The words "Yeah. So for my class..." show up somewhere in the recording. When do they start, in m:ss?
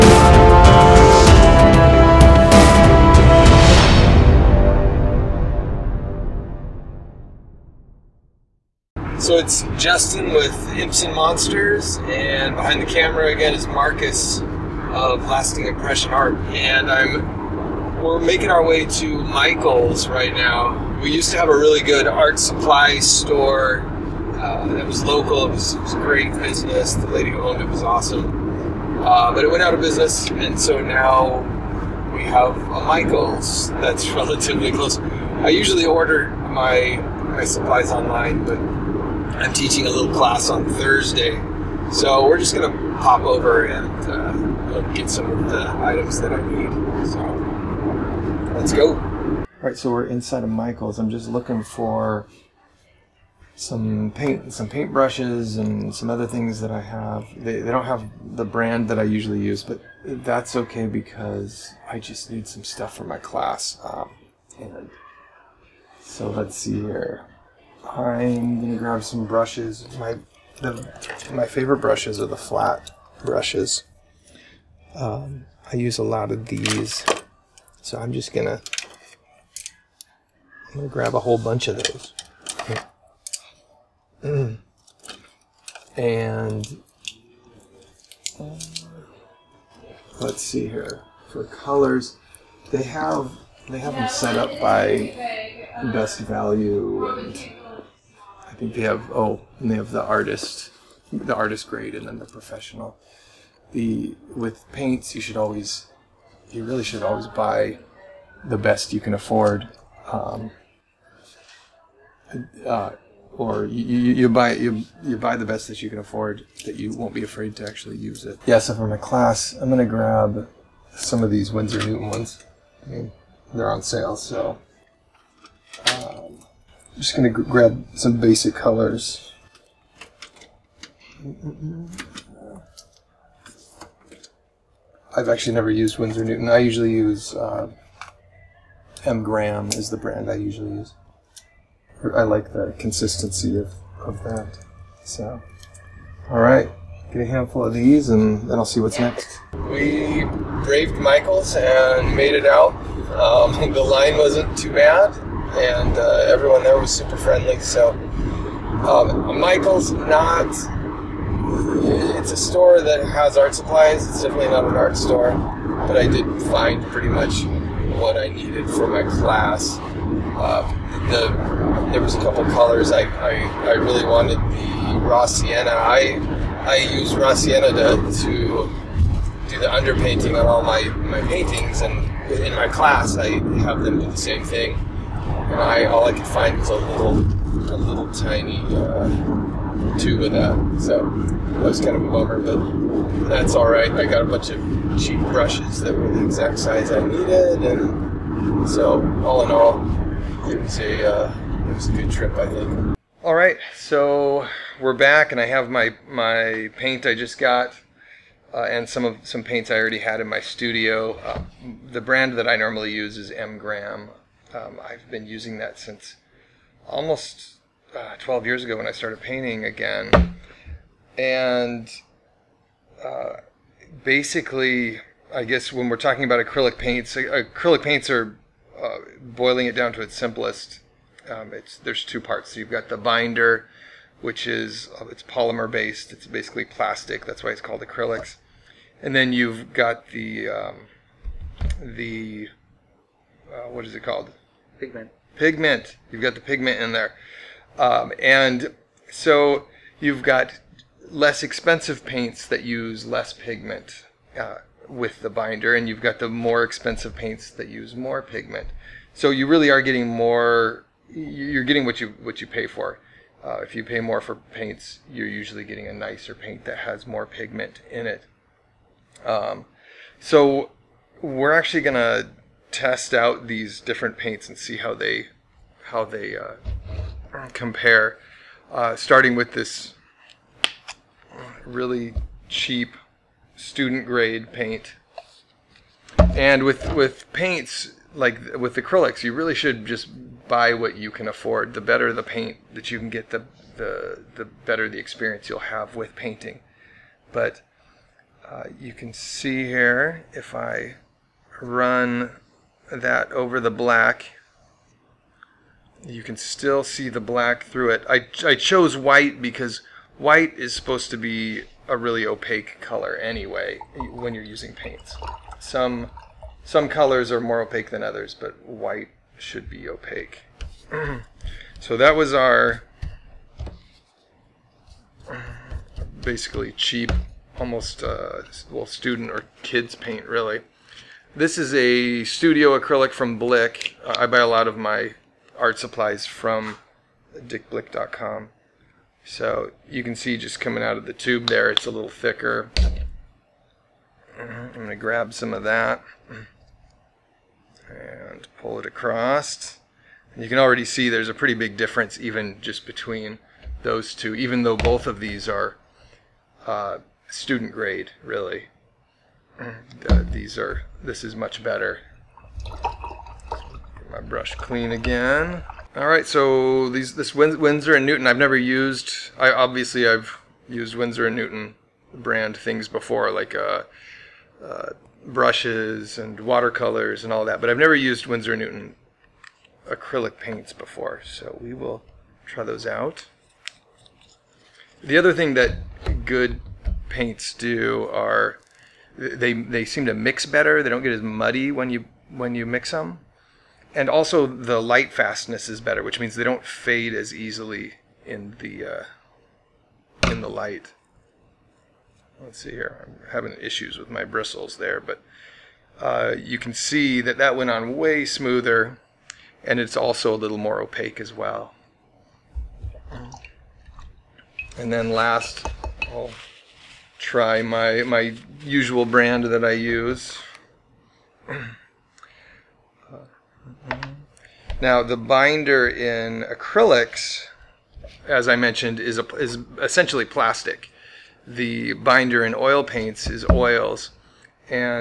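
1:58.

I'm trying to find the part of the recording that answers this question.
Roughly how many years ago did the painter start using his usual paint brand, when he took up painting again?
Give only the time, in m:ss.
3:38.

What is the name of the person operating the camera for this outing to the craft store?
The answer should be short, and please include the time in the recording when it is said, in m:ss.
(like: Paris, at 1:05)
Marcus, at 0:13.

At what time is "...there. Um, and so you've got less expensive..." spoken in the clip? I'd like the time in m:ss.
4:06.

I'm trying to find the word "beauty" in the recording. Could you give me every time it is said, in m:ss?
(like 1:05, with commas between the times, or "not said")
not said.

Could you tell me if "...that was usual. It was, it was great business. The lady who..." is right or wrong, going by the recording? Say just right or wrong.
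wrong.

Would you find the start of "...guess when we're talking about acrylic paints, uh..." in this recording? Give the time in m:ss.
3:45.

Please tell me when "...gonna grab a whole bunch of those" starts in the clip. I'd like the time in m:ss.
1:20.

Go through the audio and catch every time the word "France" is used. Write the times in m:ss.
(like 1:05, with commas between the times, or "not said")
not said.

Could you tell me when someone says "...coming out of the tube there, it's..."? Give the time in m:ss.
5:40.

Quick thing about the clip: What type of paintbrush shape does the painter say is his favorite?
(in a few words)
Flat.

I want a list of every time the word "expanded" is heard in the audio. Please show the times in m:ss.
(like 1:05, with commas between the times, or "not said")
not said.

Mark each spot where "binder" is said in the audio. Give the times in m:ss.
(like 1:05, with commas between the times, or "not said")
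3:52, 4:15, 7:05, 7:11.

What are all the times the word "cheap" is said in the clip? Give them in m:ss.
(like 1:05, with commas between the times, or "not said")
3:15, 4:42, 5:26.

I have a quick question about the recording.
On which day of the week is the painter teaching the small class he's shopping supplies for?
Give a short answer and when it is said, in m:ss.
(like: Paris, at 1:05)
Thursday, at 0:40.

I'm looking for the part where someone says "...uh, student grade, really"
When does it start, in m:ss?
5:56.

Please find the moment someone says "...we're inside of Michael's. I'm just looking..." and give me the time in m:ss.
0:49.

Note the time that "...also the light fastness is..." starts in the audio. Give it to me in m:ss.
6:34.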